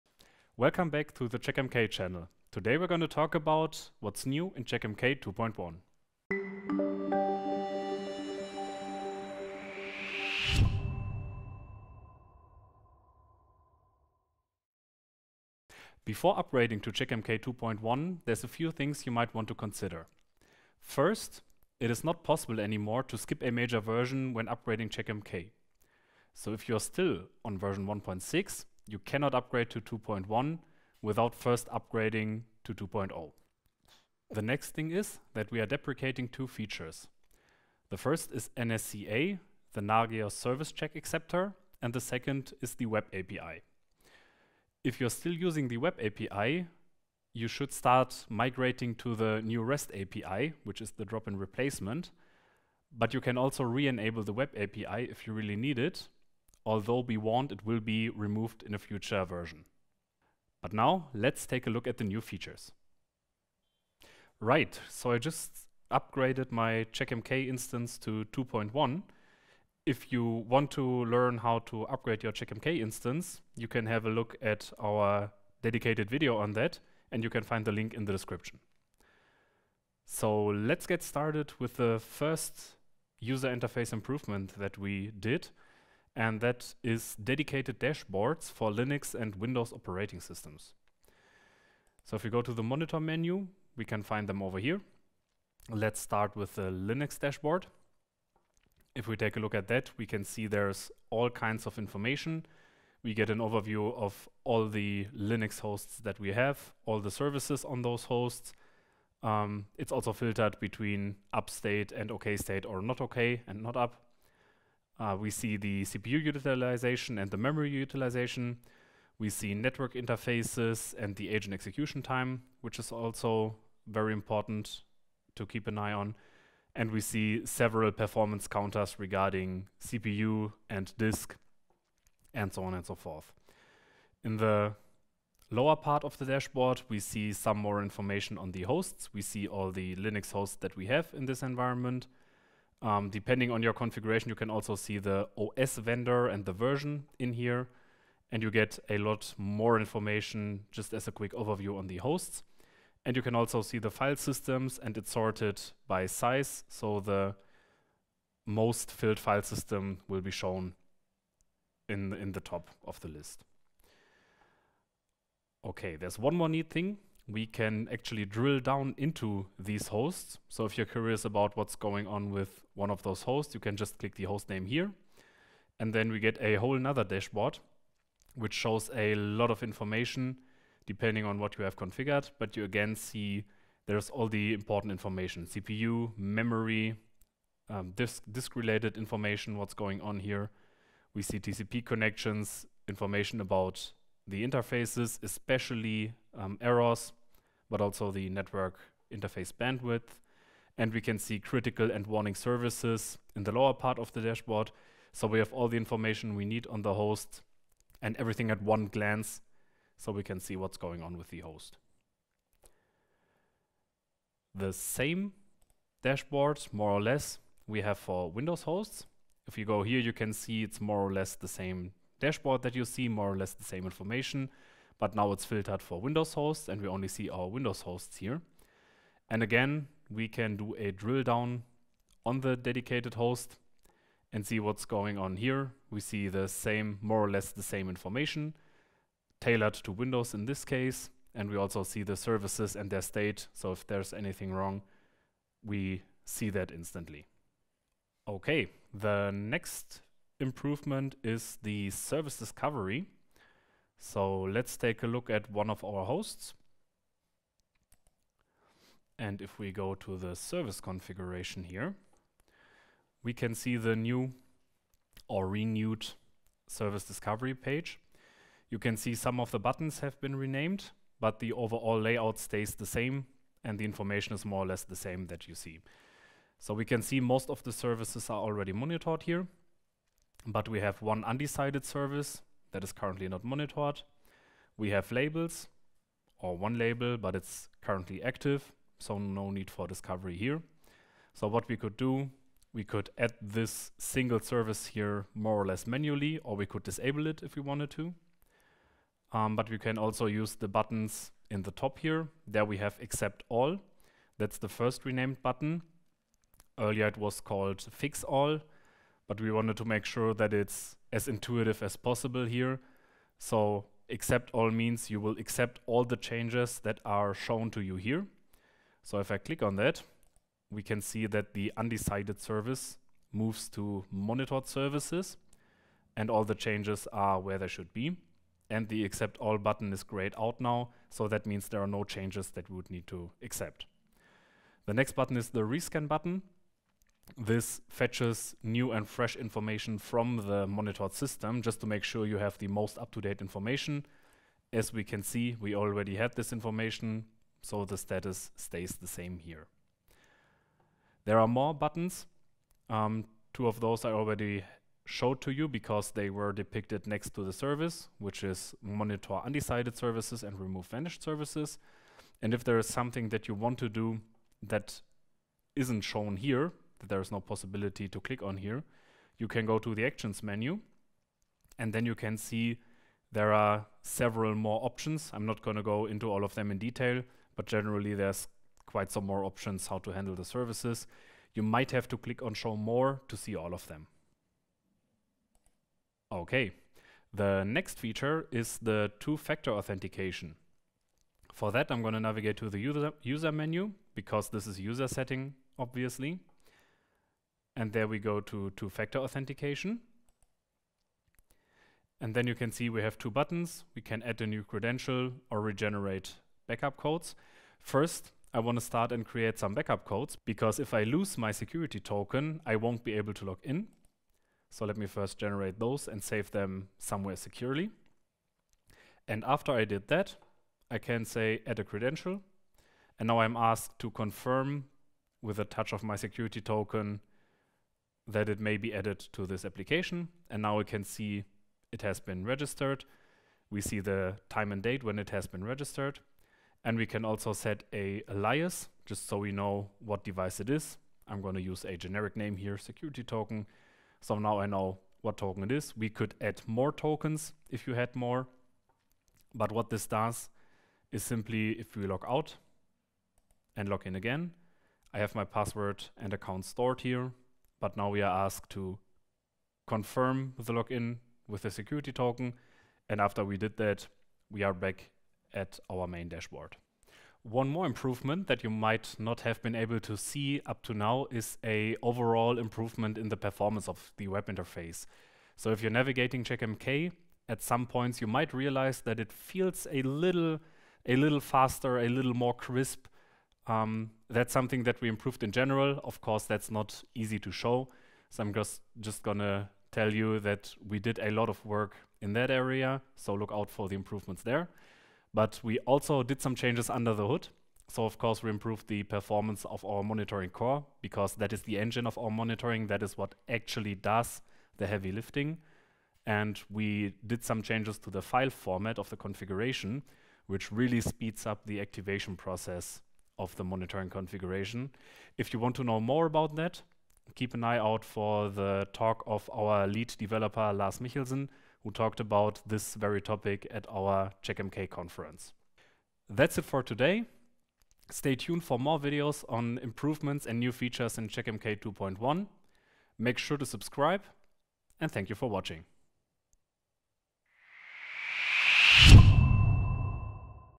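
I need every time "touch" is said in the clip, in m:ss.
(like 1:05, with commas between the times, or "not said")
7:05.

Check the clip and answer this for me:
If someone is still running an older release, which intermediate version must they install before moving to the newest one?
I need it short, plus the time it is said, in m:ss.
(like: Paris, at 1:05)
2.0, at 0:32.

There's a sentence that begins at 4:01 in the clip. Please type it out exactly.
And we also see the services and their state.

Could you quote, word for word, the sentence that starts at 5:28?
And the accept all button is grayed out now, so that means there are no changes that we would need to accept.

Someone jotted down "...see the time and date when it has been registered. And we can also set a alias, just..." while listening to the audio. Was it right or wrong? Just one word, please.
right.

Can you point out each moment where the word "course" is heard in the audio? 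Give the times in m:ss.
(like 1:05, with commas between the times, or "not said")
8:06, 8:18.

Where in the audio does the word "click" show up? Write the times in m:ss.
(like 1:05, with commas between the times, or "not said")
2:53, 5:19, 6:08, 6:22.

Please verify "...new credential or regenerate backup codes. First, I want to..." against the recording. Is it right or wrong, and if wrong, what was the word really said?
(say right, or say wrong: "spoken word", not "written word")
right.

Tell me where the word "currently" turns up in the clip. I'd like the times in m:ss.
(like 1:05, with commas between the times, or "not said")
4:42, 4:47.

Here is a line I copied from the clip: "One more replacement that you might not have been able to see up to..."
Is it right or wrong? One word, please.
wrong.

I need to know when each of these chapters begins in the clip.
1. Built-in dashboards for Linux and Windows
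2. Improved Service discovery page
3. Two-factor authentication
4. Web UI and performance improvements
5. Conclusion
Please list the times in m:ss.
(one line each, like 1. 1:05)
1. 1:03
2. 4:08
3. 6:26
4. 7:47
5. 8:46.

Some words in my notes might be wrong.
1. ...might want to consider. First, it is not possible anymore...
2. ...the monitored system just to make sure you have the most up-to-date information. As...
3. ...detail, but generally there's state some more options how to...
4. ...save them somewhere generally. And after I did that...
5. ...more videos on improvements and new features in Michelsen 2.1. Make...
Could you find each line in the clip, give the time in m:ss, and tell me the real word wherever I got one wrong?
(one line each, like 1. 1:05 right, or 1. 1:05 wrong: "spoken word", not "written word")
1. 0:19 right
2. 5:40 right
3. 6:16 wrong: "quite", not "state"
4. 6:56 wrong: "securely", not "generally"
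5. 8:48 wrong: "CheckMK", not "Michelsen".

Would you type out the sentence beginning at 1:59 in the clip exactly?
We see network interfaces and the agent execution time, which is also very important to keep an eye on.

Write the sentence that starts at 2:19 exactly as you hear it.
We see all the Linux hosts that we have in this environment.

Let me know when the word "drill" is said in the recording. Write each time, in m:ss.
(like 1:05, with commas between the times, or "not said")
2:48, 3:50.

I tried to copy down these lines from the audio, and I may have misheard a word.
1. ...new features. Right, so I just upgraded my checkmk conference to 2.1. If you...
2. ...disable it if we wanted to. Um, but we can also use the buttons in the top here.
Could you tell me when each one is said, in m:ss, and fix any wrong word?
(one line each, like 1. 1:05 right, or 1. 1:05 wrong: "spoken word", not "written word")
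1. 1:02 wrong: "instance", not "conference"
2. 4:56 right.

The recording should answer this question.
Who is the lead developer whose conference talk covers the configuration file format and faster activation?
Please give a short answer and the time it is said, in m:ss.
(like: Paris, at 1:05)
Lars Michelsen, at 8:40.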